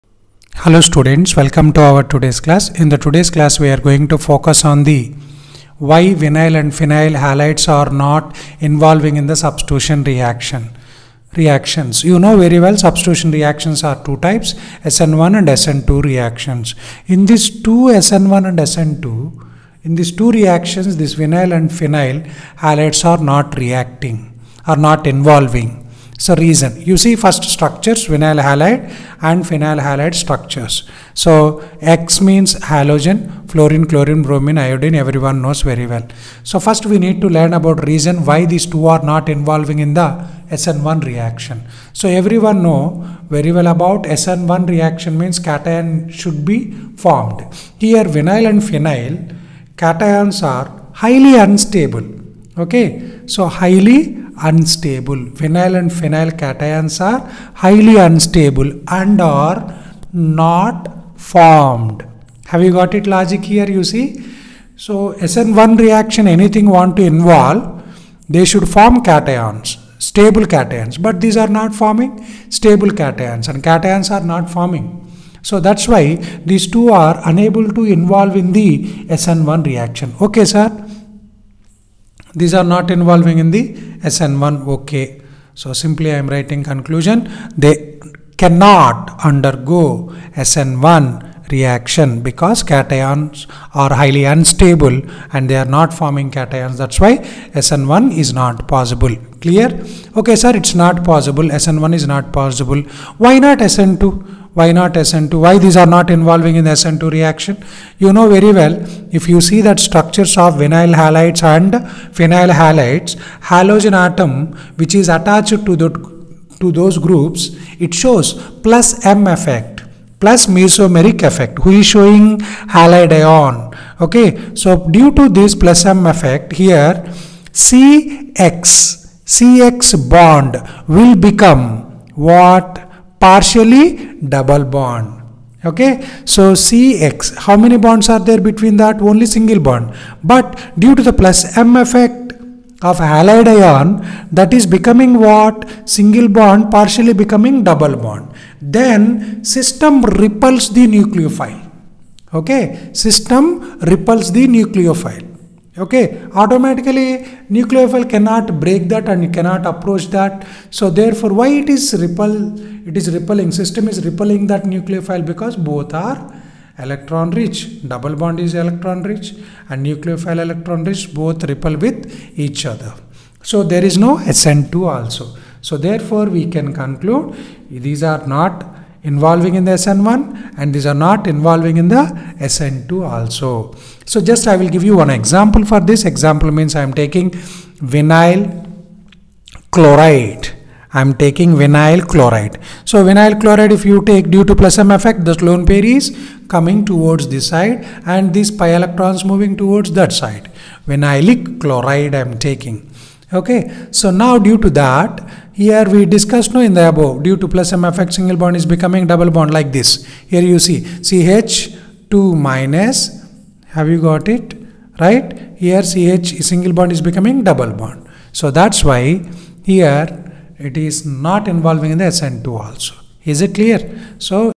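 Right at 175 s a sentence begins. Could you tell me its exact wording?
So therefore we can conclude these are not involving in the SN1 and these are not involving in the SN2 also.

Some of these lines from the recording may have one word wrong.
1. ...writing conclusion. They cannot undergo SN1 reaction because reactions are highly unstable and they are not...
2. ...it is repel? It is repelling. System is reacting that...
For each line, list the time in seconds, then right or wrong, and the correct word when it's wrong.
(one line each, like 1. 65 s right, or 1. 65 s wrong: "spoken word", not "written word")
1. 86 s wrong: "cations", not "reactions"
2. 161 s wrong: "repelling", not "reacting".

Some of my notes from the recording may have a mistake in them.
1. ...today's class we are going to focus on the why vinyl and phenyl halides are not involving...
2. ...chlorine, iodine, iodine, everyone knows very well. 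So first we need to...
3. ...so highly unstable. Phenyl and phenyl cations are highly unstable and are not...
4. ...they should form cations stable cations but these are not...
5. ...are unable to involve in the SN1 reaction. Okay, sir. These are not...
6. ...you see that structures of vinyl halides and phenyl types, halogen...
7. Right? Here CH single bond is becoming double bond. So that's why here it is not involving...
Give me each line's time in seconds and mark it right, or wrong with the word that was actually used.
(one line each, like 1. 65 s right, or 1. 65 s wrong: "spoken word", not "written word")
1. 2 s right
2. 33 s wrong: "bromine", not "iodine"
3. 53 s right
4. 68 s right
5. 76 s right
6. 109 s wrong: "halides", not "types"
7. 215 s right.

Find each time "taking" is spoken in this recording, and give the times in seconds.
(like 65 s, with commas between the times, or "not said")
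186 s, 191 s, 202 s.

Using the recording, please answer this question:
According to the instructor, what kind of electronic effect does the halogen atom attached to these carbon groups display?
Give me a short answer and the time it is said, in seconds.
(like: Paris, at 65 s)
plus mesomeric effect, at 120 s.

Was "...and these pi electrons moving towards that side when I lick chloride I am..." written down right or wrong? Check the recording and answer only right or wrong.
right.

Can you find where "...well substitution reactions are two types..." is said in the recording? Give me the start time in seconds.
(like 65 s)
12 s.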